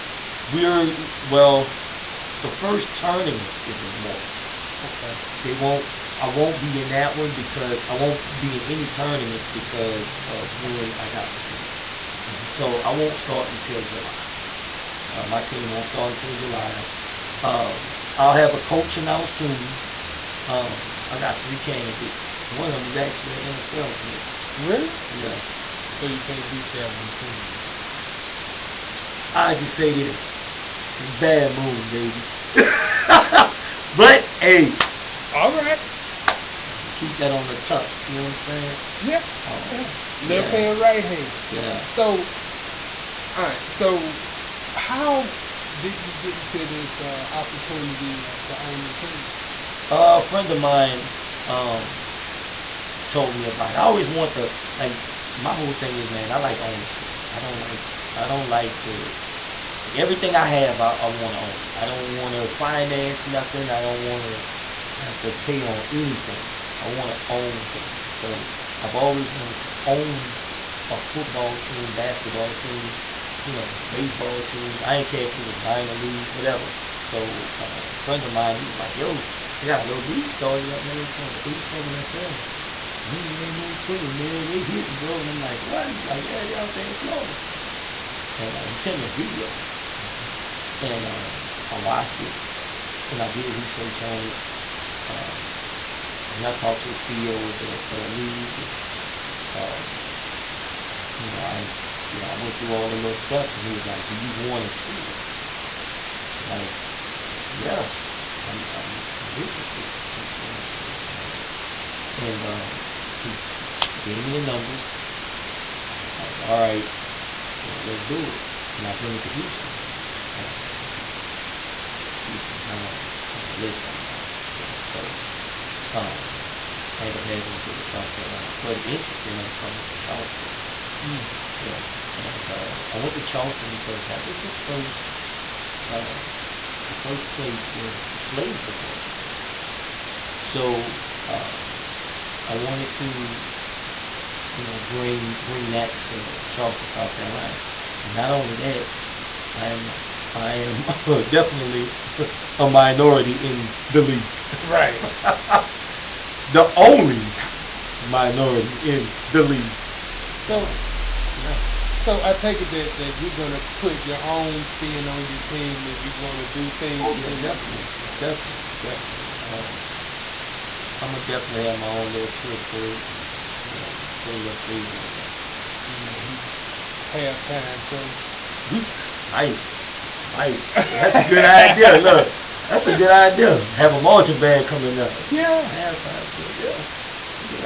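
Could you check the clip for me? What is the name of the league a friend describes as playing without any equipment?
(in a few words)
A7FL.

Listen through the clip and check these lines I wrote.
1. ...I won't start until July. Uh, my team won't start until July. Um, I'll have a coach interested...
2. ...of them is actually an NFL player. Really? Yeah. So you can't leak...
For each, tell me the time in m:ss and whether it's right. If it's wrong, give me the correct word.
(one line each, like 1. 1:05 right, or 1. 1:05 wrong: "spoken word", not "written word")
1. 0:12 wrong: "announced", not "interested"
2. 0:22 right.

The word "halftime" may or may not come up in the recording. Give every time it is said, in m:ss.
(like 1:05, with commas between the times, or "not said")
2:57, 3:05.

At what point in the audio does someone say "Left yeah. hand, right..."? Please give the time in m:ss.
0:40.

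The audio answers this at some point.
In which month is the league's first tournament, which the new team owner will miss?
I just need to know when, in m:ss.
0:03.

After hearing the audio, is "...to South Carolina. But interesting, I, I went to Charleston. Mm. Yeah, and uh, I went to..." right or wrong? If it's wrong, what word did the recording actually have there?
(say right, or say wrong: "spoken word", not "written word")
right.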